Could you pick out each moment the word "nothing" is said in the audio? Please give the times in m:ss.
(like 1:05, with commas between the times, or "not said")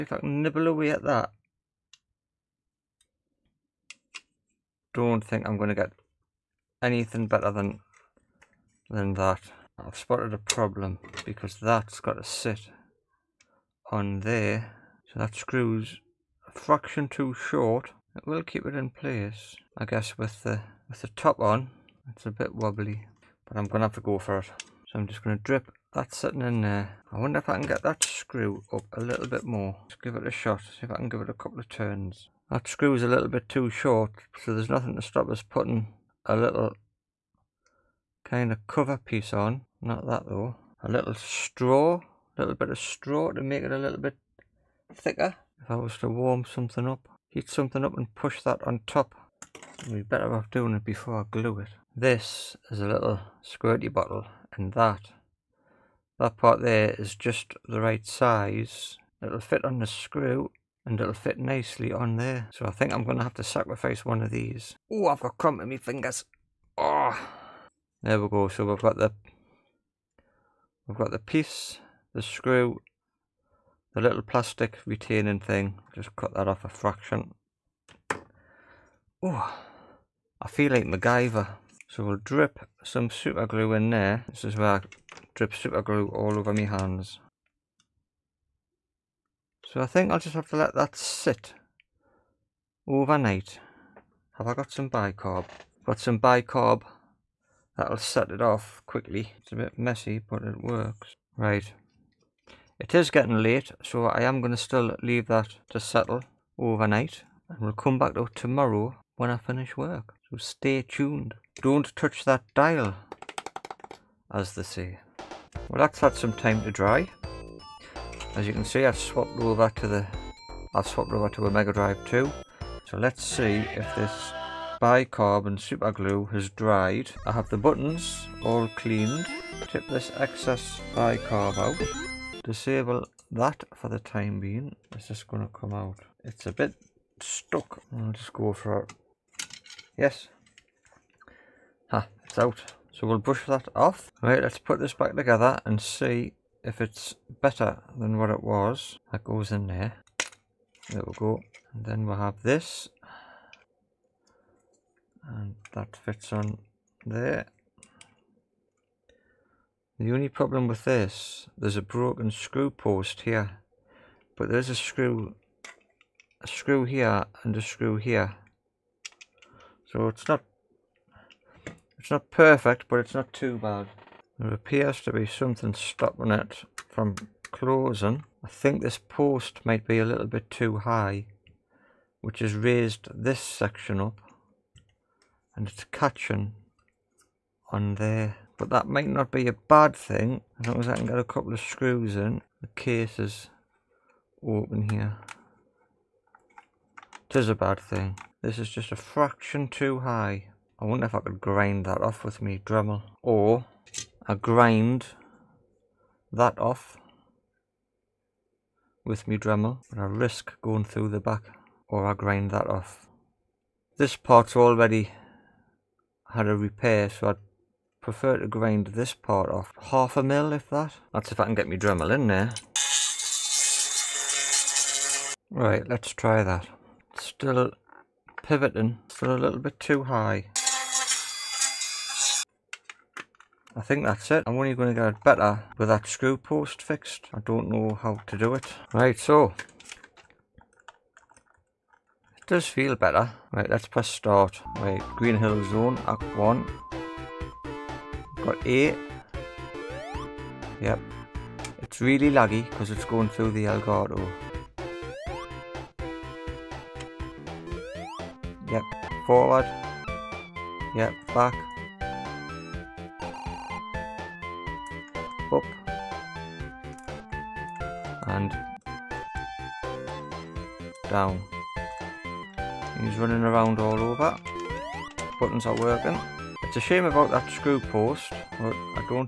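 0:34.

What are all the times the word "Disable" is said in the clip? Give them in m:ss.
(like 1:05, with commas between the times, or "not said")
2:12.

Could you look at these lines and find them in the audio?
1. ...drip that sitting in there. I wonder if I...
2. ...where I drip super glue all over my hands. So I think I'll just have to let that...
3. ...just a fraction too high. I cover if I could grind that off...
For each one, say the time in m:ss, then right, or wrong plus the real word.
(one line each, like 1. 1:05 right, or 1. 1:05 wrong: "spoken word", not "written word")
1. 0:25 right
2. 1:24 right
3. 3:18 wrong: "wonder", not "cover".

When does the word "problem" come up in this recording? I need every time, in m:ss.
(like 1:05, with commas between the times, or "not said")
0:10, 2:40.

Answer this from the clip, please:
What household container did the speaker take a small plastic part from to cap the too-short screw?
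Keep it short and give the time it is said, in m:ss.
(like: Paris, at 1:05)
squirty bottle, at 0:53.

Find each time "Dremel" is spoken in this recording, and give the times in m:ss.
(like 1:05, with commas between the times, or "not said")
3:22, 3:29, 3:41.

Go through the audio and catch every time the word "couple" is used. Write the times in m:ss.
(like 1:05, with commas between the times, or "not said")
0:31, 3:11.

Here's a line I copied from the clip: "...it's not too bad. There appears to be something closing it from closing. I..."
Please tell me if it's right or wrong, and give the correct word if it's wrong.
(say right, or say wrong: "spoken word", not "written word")
wrong: "stopping", not "closing".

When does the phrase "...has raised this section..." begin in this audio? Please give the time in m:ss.
3:02.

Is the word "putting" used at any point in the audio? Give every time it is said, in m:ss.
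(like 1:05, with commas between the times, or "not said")
0:35.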